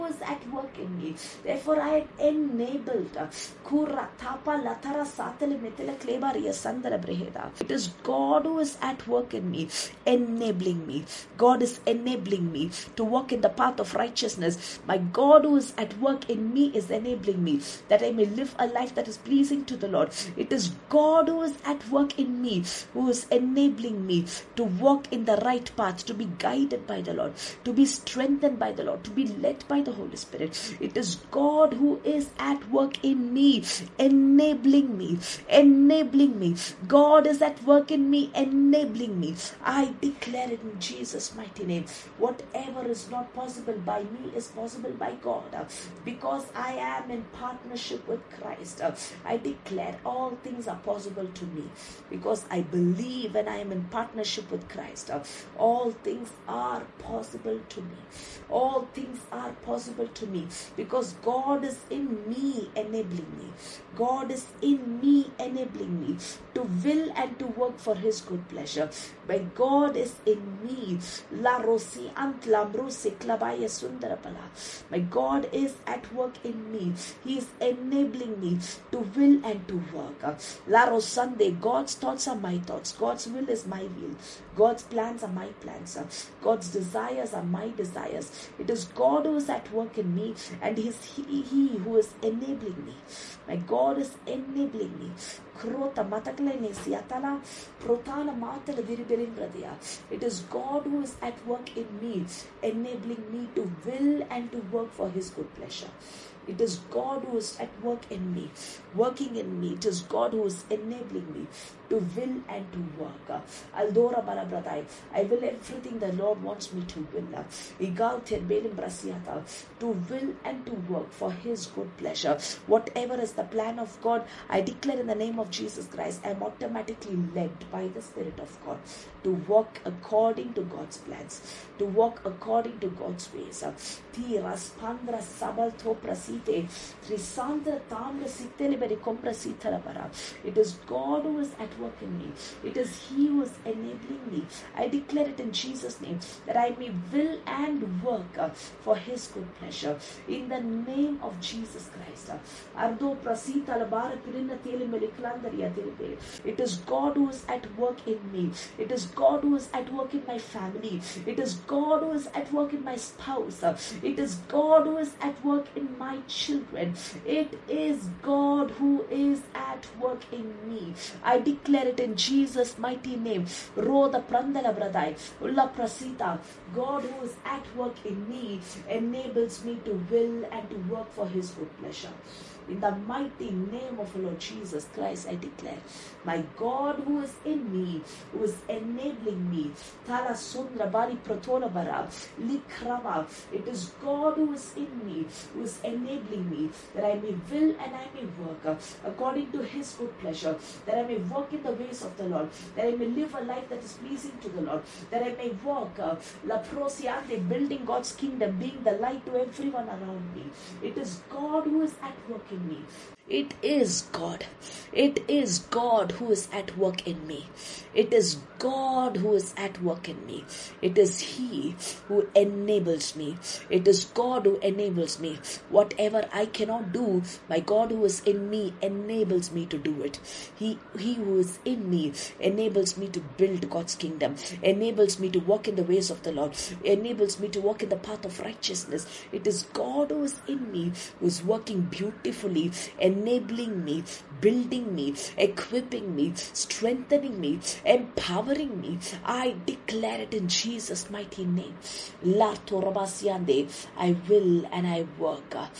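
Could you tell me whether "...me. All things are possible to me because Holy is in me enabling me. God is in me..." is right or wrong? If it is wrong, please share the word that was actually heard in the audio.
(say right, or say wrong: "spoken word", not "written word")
wrong: "God", not "Holy".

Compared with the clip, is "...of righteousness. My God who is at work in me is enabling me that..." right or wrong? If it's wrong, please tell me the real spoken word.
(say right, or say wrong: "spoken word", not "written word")
right.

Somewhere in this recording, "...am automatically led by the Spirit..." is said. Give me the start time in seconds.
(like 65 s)
126 s.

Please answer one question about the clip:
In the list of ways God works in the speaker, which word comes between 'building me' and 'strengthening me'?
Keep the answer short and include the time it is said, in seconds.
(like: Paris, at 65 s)
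equipping, at 245 s.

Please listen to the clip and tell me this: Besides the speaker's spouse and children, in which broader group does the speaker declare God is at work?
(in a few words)
my family.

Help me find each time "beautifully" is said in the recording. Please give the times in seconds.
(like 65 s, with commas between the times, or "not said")
241 s.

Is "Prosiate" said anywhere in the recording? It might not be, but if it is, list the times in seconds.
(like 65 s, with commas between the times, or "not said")
206 s.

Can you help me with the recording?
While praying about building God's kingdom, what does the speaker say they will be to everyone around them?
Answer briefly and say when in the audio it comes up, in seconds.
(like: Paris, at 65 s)
the light, at 208 s.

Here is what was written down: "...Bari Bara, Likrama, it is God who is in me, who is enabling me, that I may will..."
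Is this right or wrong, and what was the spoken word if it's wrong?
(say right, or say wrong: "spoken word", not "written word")
right.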